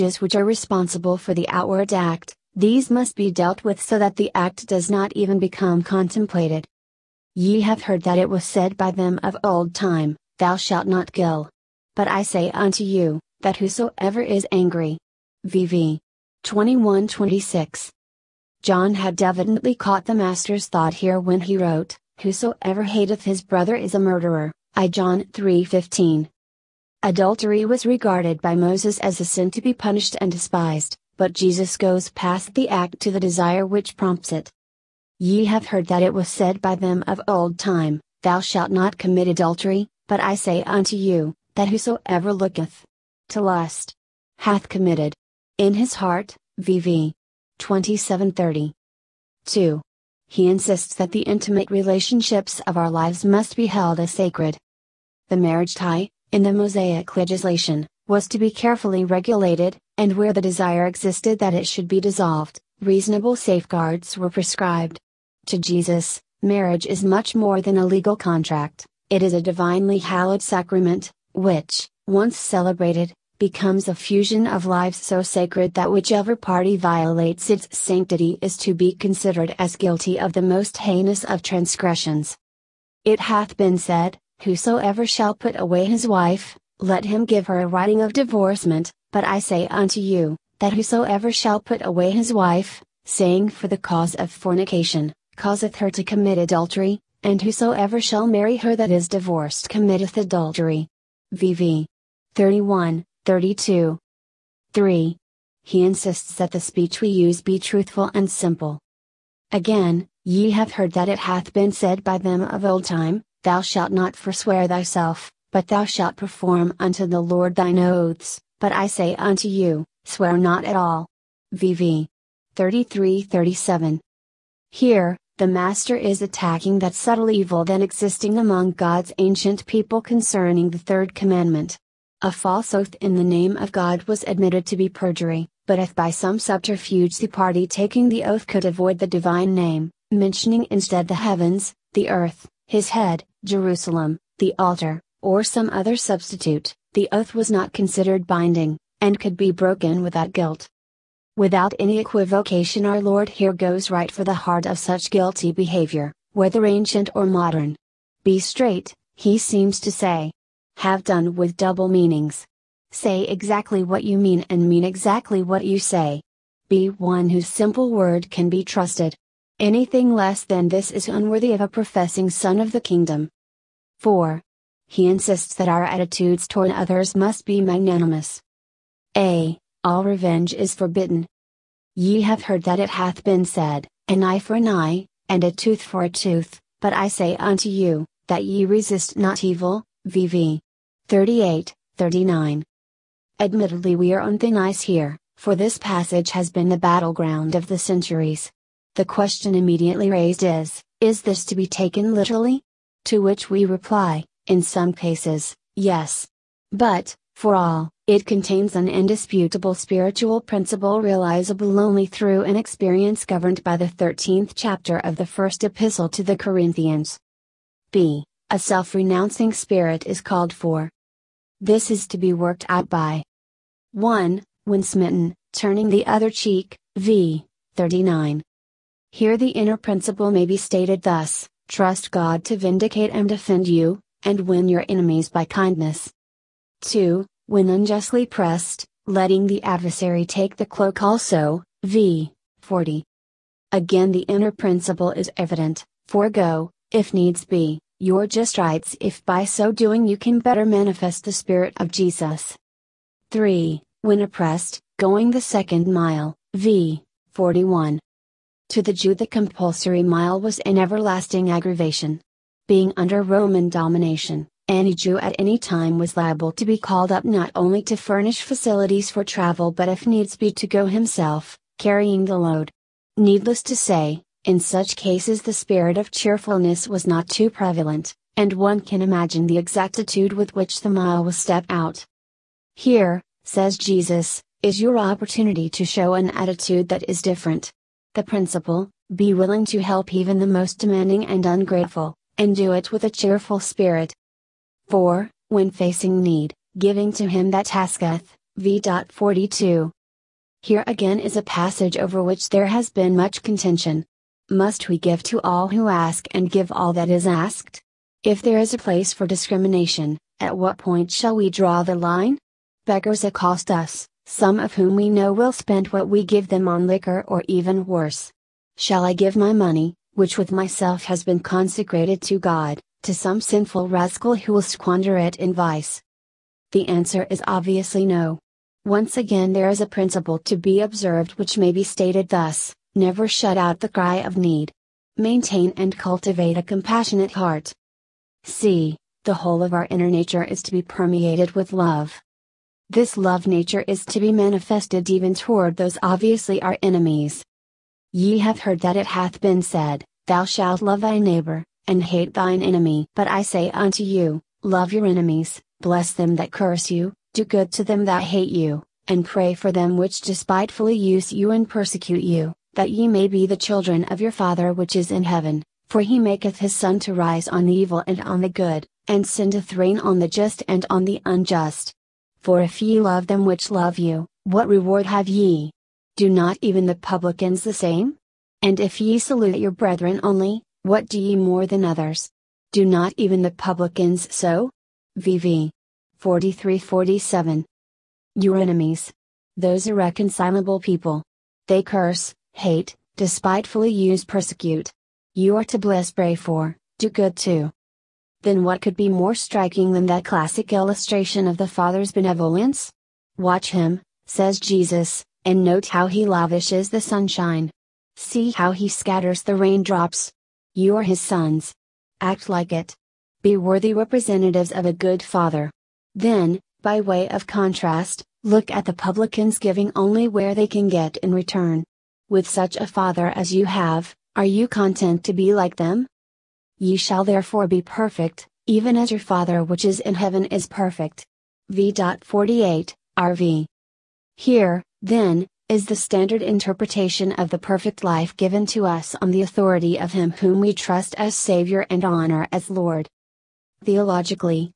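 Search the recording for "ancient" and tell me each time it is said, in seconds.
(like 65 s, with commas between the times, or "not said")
129 s, 156 s.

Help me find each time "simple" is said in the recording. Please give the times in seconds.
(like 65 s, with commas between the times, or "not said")
108 s, 167 s.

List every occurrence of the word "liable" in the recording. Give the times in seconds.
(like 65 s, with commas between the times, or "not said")
266 s.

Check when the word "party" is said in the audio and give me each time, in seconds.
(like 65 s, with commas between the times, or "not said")
76 s, 137 s.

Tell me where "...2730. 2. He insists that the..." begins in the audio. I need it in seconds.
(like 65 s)
47 s.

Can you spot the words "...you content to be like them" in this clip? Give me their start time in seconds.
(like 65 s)
424 s.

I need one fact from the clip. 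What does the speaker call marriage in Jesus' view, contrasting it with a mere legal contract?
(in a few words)
a divinely hallowed sacrament.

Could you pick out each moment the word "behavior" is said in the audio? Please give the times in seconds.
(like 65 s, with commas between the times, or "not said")
155 s.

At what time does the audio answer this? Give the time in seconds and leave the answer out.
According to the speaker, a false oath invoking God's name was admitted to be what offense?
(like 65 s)
134 s.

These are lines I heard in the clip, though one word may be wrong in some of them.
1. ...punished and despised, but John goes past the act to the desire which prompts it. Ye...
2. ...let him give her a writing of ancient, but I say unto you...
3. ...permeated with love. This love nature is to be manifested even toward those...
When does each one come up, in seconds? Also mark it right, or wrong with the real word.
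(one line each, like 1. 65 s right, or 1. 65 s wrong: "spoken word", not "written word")
1. 29 s wrong: "Jesus", not "John"
2. 86 s wrong: "divorcement", not "ancient"
3. 340 s right.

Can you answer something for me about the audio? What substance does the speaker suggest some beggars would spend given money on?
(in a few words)
liquor.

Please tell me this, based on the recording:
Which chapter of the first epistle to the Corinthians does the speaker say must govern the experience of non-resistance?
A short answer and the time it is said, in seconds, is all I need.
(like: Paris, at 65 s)
13th, at 213 s.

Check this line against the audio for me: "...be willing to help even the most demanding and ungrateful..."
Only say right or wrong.
right.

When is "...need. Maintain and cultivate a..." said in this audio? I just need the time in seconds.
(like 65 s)
334 s.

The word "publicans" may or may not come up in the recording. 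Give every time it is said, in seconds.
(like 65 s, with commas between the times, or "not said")
376 s, 383 s, 418 s.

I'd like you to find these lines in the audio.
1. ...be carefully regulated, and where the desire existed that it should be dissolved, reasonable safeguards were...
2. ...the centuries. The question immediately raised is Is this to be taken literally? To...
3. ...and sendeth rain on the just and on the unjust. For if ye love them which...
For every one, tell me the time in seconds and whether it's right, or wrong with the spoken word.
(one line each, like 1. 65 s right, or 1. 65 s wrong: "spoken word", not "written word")
1. 58 s right
2. 197 s right
3. 369 s right.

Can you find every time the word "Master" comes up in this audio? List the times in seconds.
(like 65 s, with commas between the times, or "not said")
20 s, 125 s.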